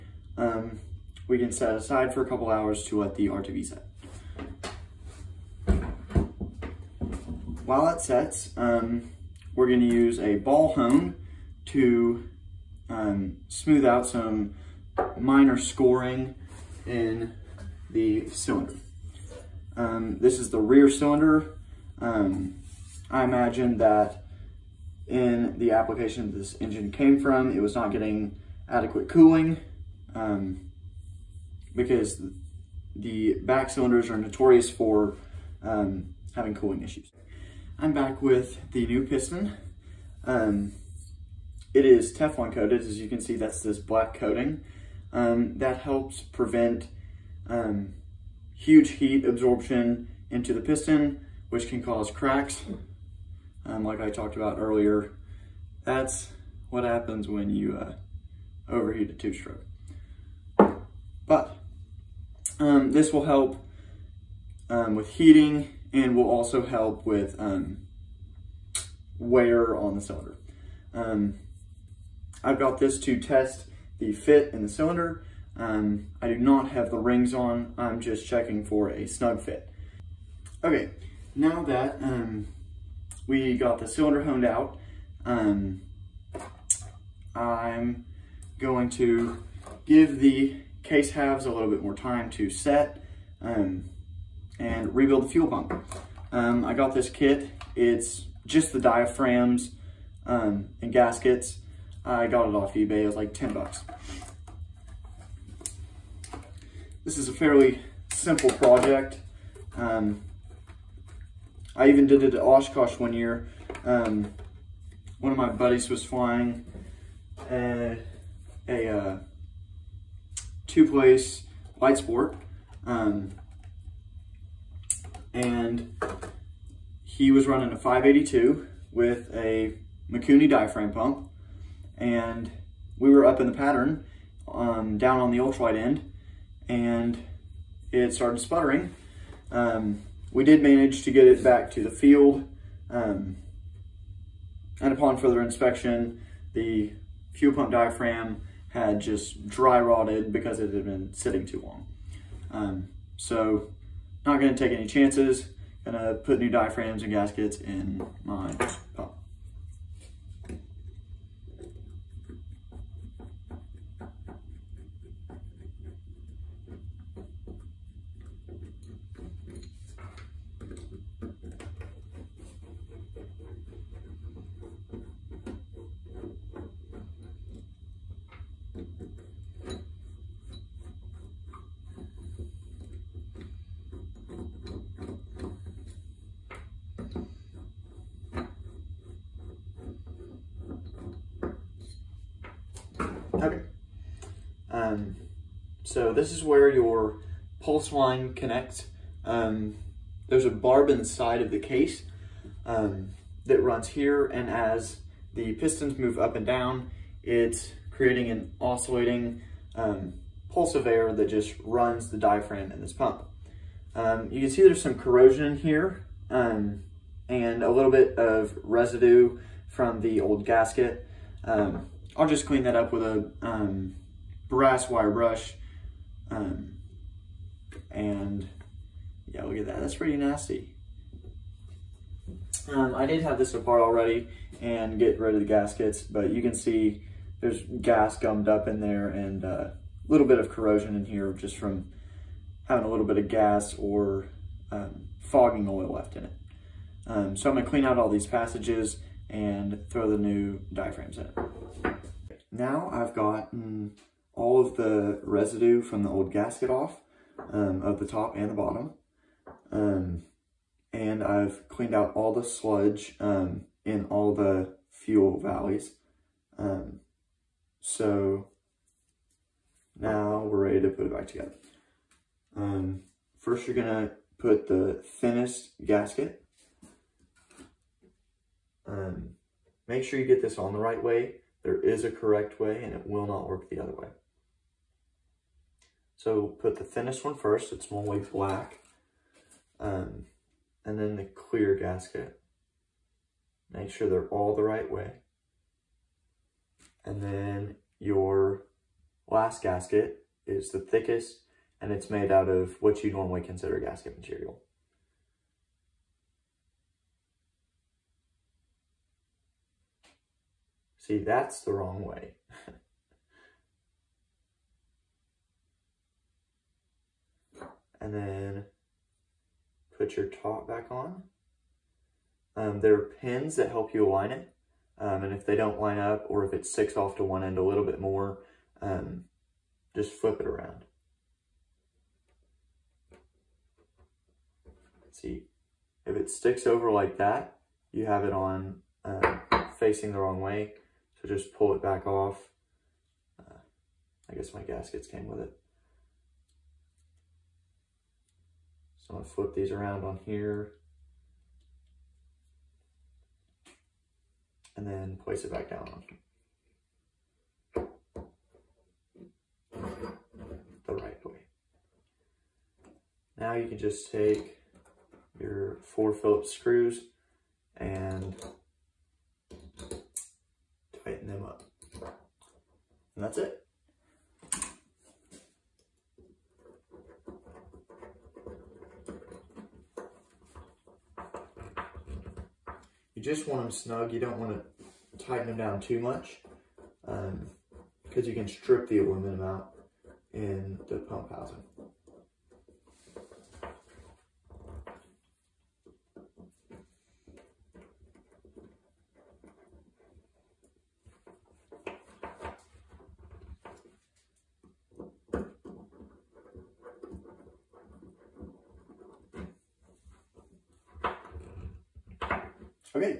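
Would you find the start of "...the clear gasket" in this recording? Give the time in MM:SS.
04:51.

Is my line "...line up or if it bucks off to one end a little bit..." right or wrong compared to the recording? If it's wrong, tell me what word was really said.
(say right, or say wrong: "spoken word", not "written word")
wrong: "sticks", not "bucks".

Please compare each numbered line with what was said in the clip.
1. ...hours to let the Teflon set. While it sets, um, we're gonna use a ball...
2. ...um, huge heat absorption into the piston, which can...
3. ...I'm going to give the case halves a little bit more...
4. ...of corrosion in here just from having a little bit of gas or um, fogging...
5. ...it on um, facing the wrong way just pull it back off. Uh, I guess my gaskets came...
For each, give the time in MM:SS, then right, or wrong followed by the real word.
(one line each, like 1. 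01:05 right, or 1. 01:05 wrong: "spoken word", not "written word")
1. 00:02 wrong: "RTV", not "Teflon"
2. 00:47 right
3. 01:27 right
4. 04:00 right
5. 05:38 right.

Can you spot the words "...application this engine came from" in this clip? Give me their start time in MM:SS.
00:25.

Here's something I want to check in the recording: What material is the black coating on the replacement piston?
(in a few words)
Teflon.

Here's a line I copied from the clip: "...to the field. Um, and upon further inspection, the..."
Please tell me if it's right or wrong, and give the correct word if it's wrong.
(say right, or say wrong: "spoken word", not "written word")
right.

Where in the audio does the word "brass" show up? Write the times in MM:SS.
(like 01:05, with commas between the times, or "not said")
03:44.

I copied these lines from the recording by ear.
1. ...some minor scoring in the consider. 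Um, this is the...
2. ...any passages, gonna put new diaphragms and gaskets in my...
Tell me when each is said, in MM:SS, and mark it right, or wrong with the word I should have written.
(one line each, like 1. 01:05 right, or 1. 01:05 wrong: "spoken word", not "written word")
1. 00:14 wrong: "cylinder", not "consider"
2. 02:34 wrong: "chances", not "passages".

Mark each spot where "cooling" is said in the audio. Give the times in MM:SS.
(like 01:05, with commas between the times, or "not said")
00:29, 00:36.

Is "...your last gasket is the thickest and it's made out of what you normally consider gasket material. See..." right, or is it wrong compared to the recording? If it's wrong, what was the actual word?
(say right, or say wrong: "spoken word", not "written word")
right.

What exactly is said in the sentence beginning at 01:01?
But um, this will help um, with heating and will also help with um, wear on the cylinder.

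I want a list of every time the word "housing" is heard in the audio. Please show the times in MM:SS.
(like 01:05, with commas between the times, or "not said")
06:31.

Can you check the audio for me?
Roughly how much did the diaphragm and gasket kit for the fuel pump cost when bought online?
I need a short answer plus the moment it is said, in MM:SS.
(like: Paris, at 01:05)
$10, at 01:43.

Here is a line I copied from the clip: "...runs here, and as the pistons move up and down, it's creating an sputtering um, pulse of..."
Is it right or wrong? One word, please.
wrong.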